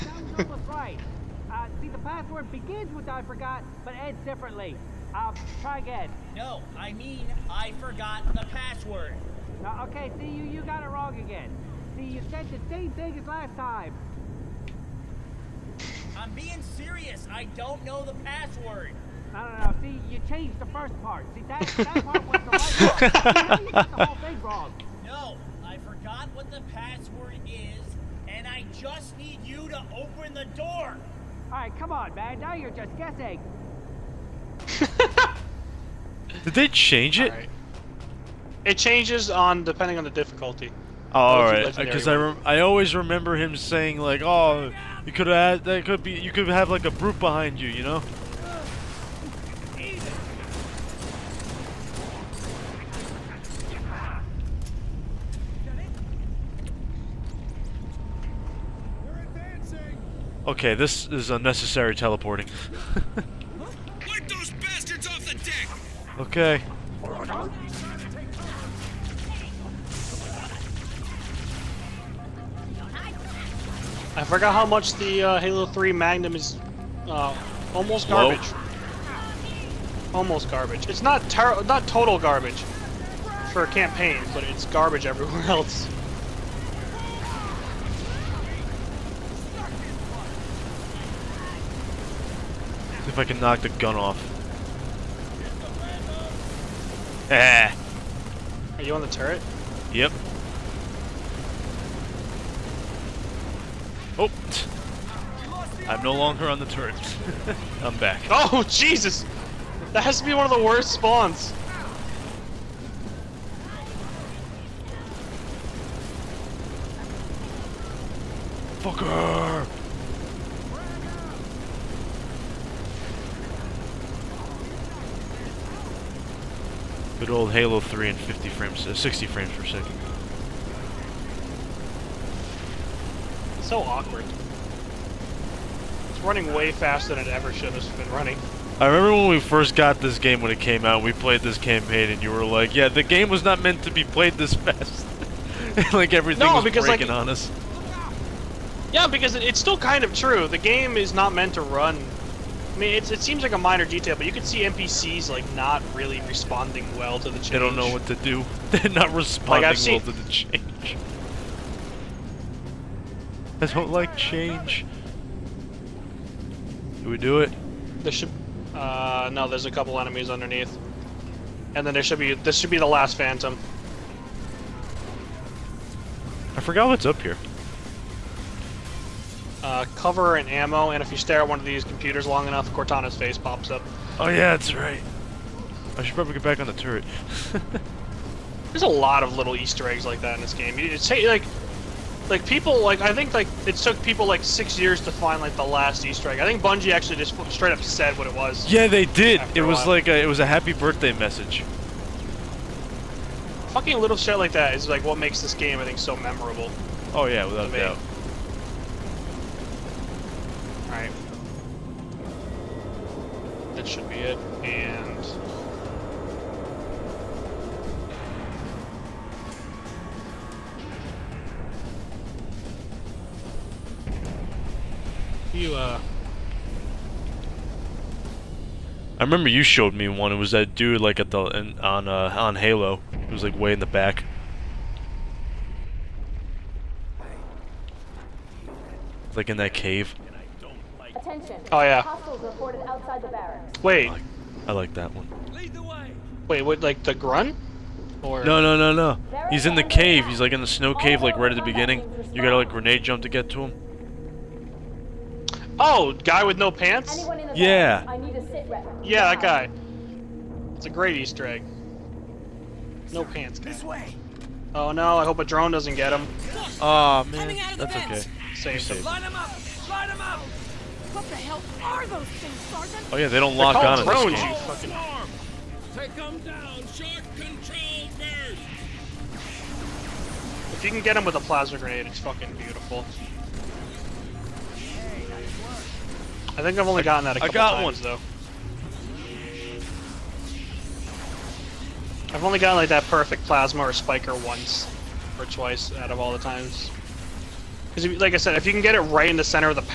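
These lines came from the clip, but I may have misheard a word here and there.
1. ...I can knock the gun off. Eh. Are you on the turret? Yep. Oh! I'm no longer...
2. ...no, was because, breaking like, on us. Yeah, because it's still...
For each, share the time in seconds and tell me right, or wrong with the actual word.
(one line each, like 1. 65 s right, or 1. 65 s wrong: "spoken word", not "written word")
1. 93 s right
2. 146 s right.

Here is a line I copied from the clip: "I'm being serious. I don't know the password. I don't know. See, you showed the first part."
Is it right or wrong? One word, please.
wrong.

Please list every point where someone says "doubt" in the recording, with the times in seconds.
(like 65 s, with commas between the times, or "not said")
207 s.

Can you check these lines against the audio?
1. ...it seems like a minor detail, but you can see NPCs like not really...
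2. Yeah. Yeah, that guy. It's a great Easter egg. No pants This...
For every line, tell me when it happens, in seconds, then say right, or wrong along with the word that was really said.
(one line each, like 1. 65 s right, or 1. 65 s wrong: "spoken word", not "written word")
1. 152 s right
2. 257 s right.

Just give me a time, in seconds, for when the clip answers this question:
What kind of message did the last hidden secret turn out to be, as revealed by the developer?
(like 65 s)
200 s.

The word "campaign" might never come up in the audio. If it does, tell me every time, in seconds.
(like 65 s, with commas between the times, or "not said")
83 s, 141 s.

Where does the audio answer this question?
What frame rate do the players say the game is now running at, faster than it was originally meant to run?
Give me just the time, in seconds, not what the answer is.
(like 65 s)
128 s.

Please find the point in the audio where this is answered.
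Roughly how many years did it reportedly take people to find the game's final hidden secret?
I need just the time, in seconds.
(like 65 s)
194 s.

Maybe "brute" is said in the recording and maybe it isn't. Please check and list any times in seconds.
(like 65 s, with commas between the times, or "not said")
46 s.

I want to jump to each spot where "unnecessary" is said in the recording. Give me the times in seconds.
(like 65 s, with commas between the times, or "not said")
61 s.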